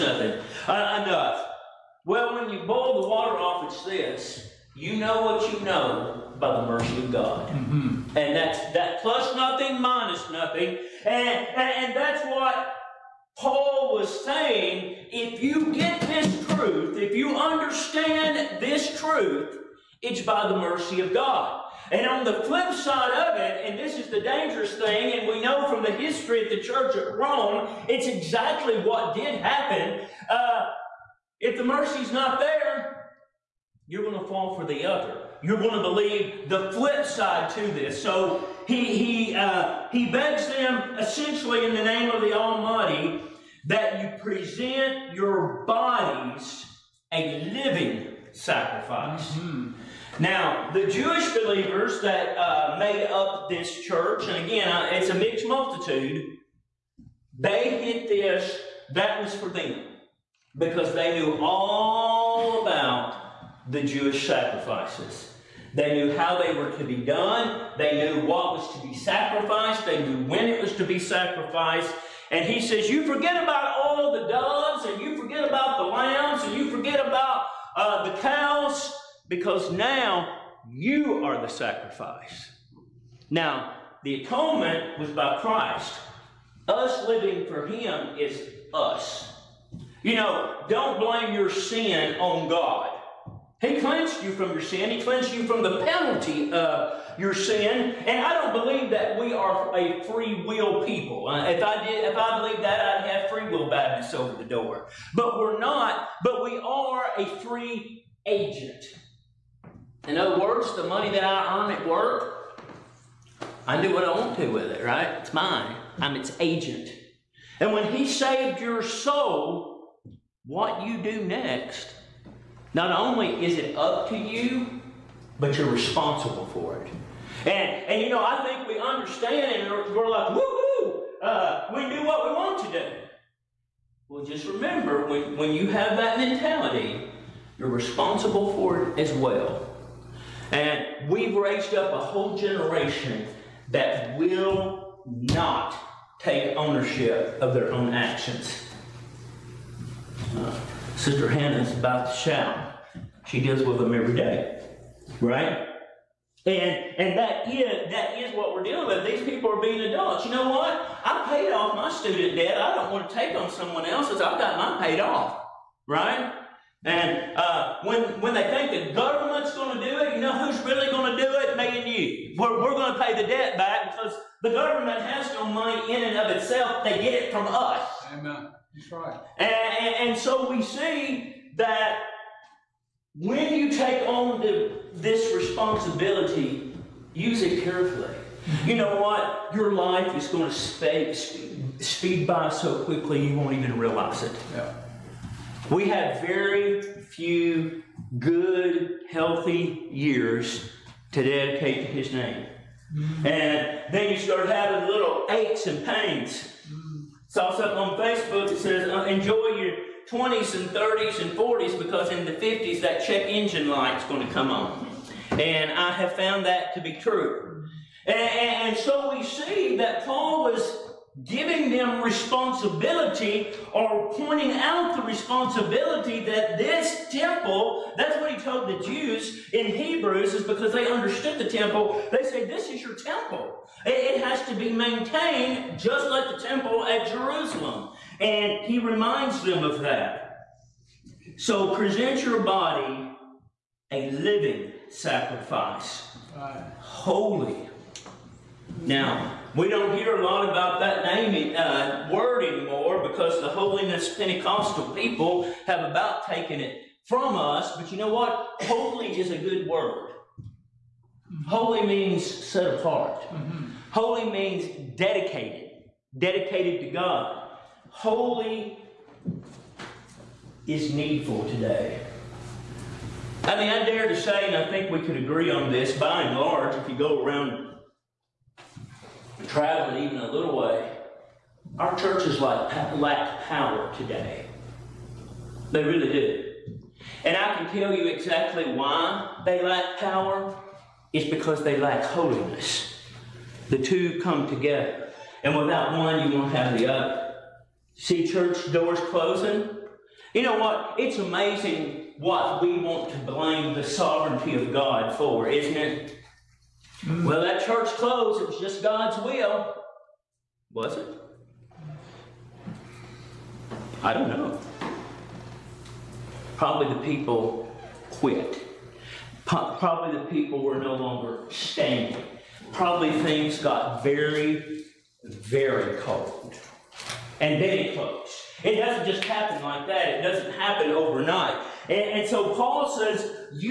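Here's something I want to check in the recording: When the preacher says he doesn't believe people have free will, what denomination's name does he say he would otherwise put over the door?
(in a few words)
Free Will Baptists.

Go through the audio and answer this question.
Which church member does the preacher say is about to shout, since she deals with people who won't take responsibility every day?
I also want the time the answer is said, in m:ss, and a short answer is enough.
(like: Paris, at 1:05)
Sister Hannah, at 2:30.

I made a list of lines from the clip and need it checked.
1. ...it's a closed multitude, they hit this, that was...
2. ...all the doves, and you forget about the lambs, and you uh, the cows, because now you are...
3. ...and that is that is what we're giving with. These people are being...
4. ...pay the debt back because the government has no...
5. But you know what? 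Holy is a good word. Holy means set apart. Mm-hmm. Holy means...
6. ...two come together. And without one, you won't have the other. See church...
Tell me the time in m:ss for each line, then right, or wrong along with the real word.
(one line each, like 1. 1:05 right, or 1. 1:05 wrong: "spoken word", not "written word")
1. 0:54 wrong: "mixed", not "closed"
2. 1:13 right
3. 2:36 wrong: "dealing", not "giving"
4. 2:53 right
5. 4:17 right
6. 4:53 right.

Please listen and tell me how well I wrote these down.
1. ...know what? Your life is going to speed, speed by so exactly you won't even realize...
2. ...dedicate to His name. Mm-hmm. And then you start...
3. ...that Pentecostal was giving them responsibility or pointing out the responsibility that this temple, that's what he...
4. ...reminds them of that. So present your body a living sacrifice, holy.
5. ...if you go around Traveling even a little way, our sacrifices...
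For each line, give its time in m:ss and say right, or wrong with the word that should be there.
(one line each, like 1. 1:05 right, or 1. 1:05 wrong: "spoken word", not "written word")
1. 3:08 wrong: "quickly", not "exactly"
2. 3:21 right
3. 3:39 wrong: "Paul", not "Pentecostal"
4. 3:58 right
5. 4:36 wrong: "churches", not "sacrifices".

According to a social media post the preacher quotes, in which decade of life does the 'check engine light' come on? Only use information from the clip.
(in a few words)
50s.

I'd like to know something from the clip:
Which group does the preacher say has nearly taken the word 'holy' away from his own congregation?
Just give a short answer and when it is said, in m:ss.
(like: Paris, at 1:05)
holiness Pentecostal people, at 4:13.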